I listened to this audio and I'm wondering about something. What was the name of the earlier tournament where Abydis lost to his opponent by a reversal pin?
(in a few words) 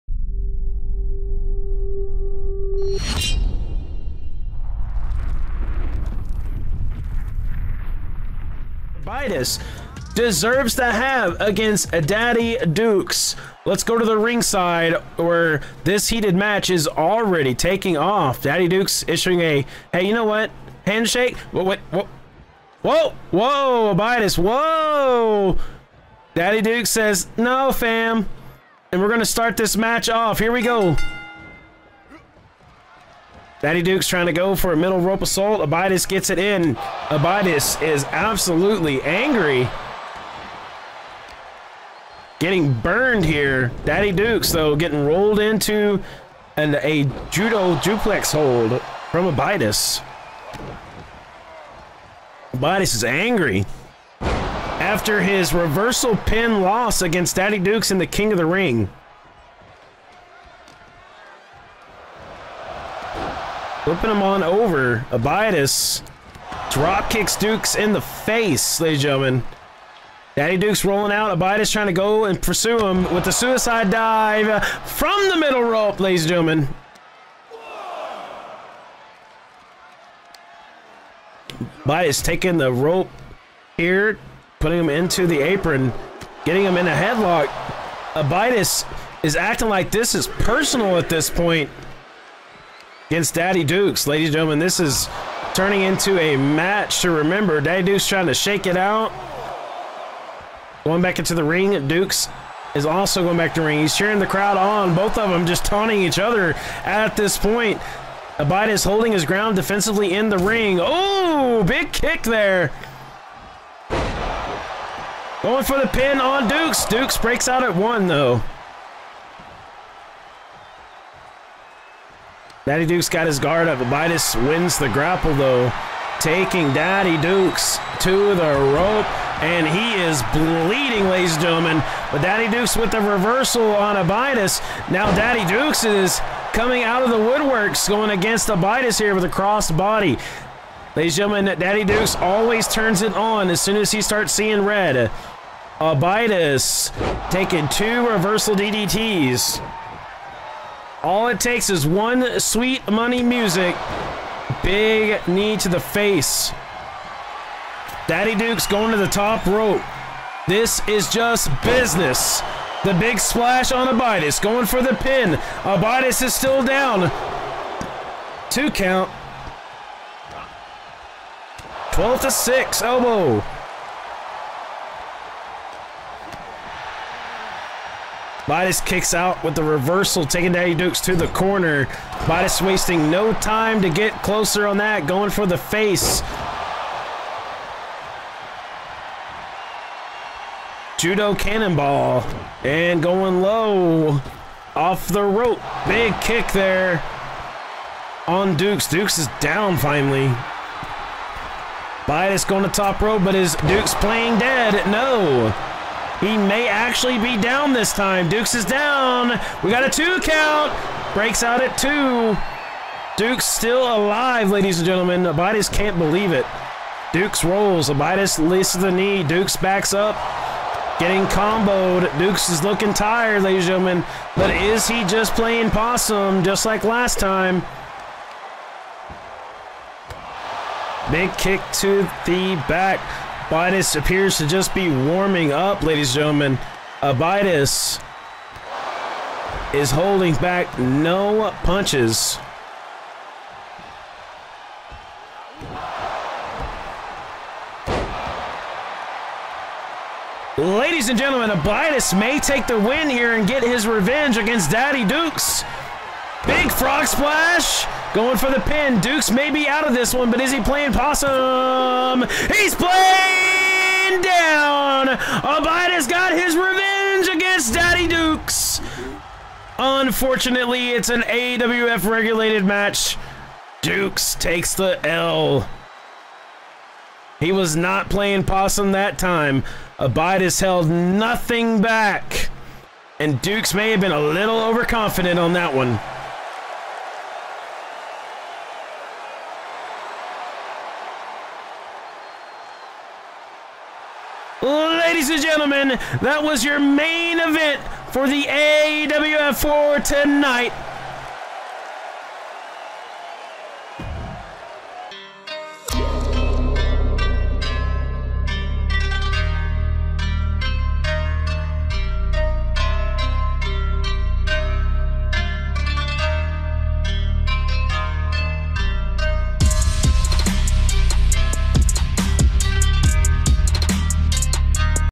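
King of the Ring.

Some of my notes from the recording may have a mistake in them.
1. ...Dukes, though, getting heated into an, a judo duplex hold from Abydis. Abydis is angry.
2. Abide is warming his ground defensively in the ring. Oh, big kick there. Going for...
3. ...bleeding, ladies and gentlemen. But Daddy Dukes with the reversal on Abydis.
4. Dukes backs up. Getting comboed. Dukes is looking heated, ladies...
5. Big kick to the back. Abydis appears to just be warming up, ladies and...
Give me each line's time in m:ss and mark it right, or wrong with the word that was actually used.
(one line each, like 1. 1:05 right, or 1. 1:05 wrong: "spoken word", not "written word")
1. 0:44 wrong: "rolled", not "heated"
2. 1:48 wrong: "holding", not "warming"
3. 2:10 right
4. 3:39 wrong: "tired", not "heated"
5. 3:51 right.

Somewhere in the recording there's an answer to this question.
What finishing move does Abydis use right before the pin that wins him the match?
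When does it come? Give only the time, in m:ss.
4:16.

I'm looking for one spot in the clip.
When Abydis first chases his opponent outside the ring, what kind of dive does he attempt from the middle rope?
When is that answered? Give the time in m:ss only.
1:13.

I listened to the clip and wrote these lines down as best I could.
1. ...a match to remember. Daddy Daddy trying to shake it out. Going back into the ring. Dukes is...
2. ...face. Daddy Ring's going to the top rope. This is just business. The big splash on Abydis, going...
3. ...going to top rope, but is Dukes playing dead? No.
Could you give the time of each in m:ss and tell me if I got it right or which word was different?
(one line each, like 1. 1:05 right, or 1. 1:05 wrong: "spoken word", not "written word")
1. 1:36 wrong: "Dukes", not "Daddy"
2. 2:35 wrong: "Duke", not "Ring"
3. 3:22 right.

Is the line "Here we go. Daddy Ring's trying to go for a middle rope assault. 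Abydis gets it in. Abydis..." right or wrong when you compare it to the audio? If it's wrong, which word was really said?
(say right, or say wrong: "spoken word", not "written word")
wrong: "Duke", not "Ring".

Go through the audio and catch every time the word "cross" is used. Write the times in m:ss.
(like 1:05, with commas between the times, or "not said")
2:19.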